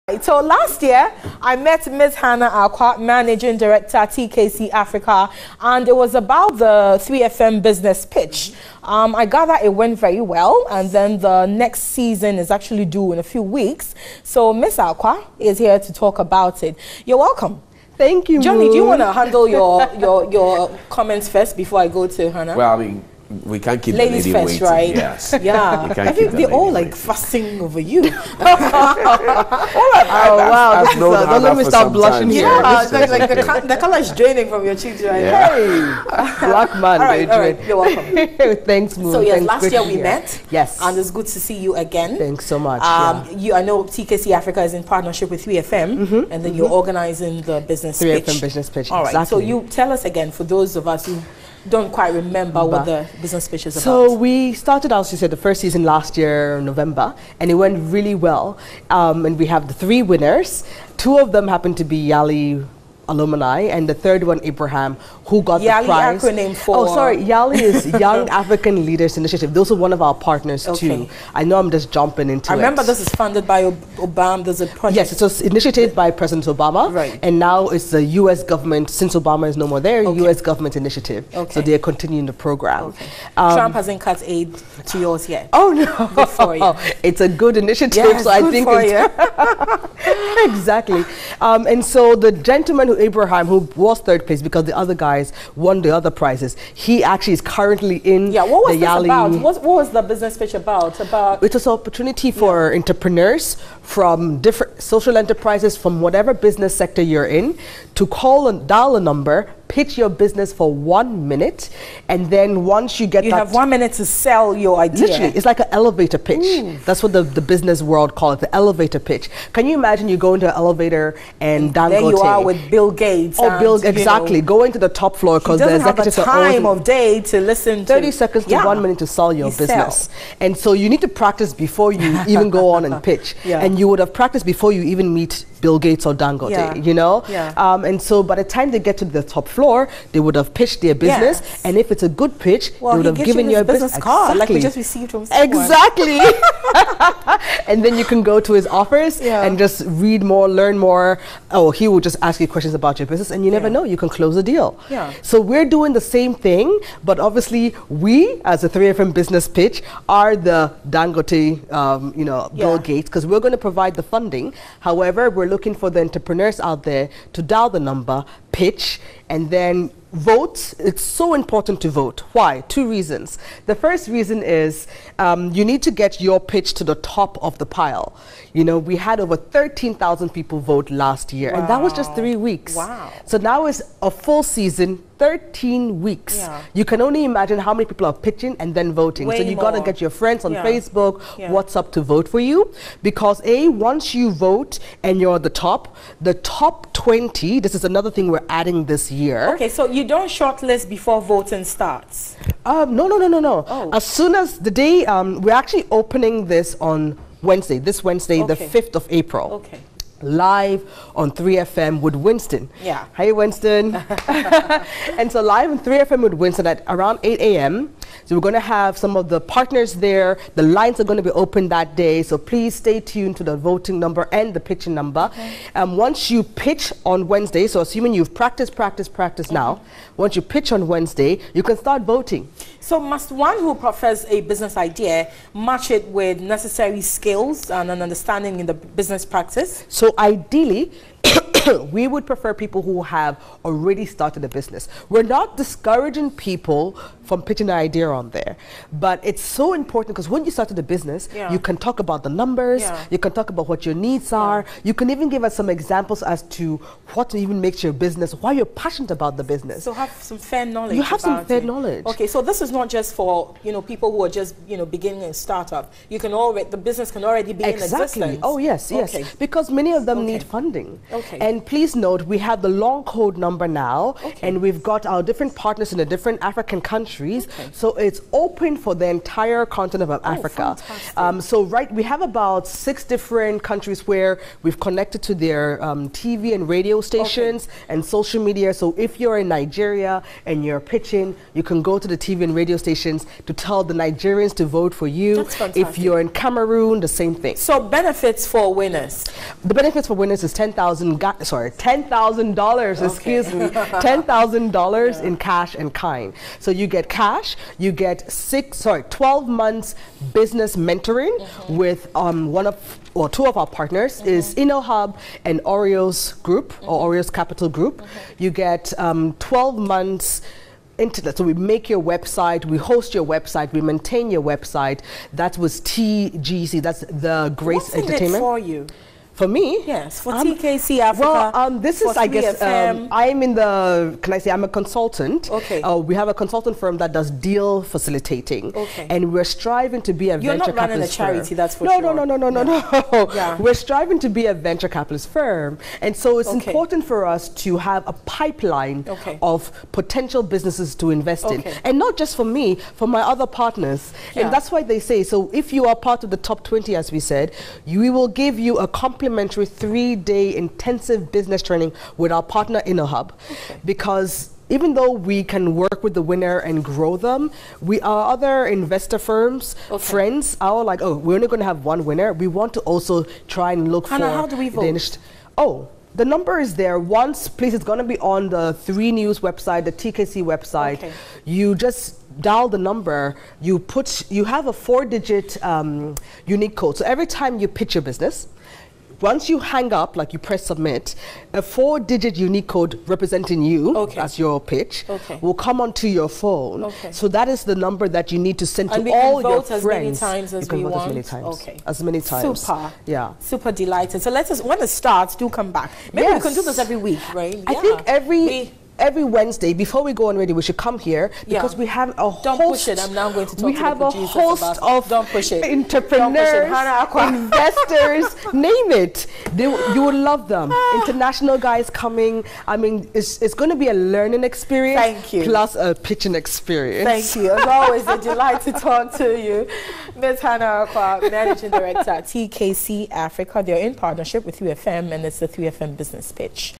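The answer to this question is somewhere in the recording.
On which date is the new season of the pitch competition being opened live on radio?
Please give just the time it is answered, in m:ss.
3:28.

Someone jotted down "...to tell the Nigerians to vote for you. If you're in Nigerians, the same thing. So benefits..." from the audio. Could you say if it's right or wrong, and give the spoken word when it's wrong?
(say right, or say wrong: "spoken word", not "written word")
wrong: "Cameroon", not "Nigerians".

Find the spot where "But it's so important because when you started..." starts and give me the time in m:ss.
4:08.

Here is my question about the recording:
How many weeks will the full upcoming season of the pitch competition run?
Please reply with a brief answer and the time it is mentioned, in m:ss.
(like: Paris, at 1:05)
13 weeks, at 3:05.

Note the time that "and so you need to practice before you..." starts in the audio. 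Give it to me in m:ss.
2:10.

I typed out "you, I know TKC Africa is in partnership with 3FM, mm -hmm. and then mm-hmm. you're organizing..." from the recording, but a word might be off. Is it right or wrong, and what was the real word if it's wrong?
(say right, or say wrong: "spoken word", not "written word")
right.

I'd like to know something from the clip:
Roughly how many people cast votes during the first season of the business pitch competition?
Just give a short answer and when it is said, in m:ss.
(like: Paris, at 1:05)
13,000, at 2:59.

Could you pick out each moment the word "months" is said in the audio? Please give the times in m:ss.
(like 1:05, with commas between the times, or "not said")
5:09, 5:19.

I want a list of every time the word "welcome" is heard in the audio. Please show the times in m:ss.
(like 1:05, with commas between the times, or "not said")
0:17, 0:37.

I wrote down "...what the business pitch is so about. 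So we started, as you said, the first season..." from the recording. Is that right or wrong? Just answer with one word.
right.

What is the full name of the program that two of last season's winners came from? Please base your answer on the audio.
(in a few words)
Young African Leaders Initiative.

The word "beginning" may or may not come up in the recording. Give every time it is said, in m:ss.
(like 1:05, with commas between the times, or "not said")
4:24.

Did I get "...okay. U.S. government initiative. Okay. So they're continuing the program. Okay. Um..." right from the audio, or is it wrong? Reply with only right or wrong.
right.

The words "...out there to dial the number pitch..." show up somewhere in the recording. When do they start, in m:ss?
2:46.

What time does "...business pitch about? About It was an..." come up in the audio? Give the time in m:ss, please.
1:40.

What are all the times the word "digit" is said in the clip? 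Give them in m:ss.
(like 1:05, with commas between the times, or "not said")
6:24, 6:31.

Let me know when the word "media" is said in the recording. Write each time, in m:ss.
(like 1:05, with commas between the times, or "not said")
4:48.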